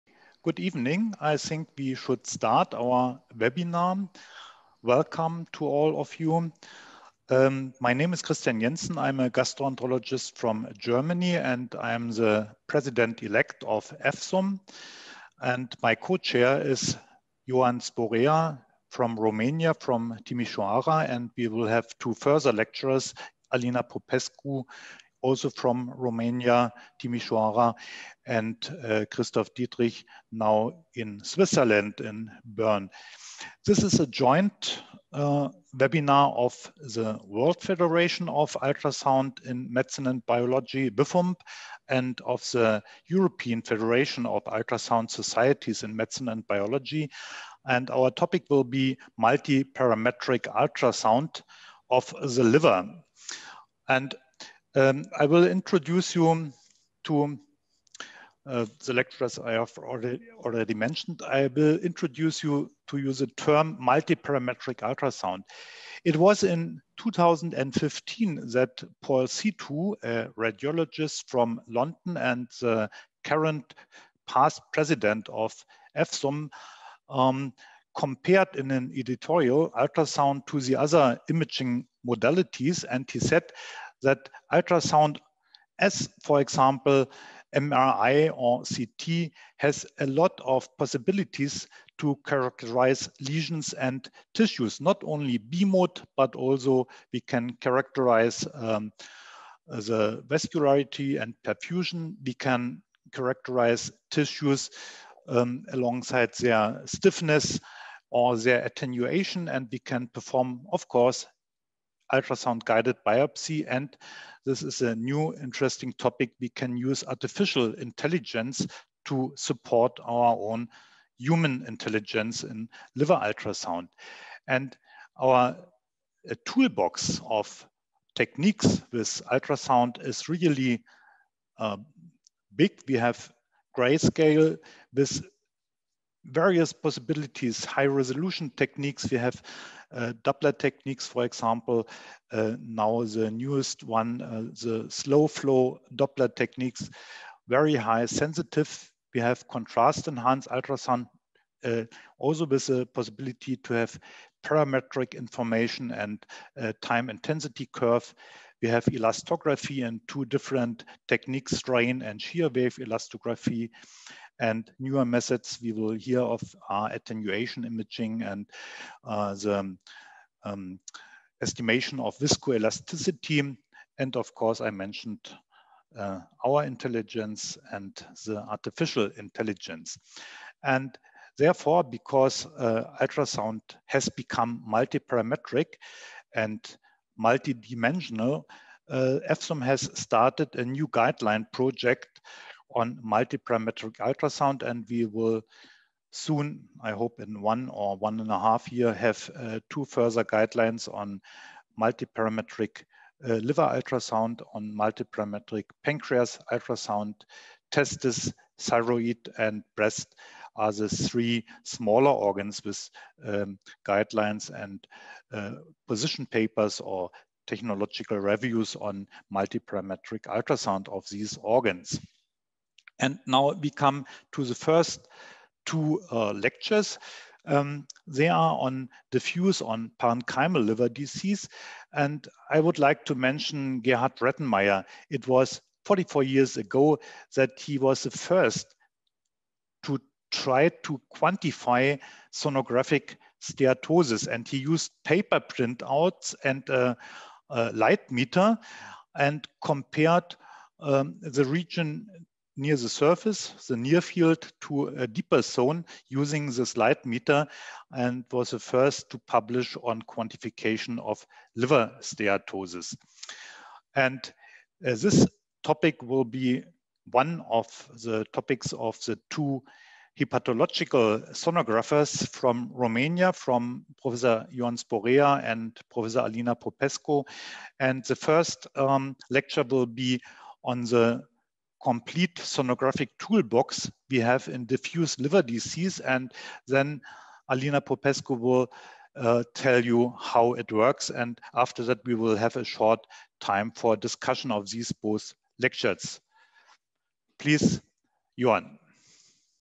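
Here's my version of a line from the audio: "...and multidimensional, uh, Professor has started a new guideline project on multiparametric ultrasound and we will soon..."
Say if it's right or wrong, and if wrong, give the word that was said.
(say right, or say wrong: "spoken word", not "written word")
wrong: "EFSUMB", not "Professor".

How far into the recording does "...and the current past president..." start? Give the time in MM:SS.
01:12.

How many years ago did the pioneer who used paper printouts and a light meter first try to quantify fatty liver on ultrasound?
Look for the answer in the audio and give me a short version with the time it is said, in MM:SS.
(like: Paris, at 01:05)
44, at 03:55.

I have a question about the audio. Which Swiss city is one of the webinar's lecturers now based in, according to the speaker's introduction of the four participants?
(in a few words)
Bern.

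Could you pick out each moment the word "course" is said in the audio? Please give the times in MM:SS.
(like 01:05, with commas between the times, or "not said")
01:50, 02:54.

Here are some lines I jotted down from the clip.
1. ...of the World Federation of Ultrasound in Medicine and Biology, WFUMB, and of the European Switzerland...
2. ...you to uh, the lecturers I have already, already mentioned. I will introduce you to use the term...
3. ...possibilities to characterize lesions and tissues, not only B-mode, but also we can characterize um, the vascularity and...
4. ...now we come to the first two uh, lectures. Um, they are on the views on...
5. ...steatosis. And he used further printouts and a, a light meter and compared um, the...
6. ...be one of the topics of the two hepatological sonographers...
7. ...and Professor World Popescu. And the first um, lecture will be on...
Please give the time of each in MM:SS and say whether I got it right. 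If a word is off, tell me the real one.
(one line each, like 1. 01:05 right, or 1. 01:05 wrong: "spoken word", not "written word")
1. 00:36 wrong: "Federation", not "Switzerland"
2. 00:56 right
3. 01:30 right
4. 03:43 right
5. 04:03 wrong: "paper", not "further"
6. 04:26 right
7. 04:35 wrong: "Alina", not "World".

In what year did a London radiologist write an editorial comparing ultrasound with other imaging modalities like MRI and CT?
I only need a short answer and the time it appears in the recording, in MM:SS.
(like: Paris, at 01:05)
2015, at 01:06.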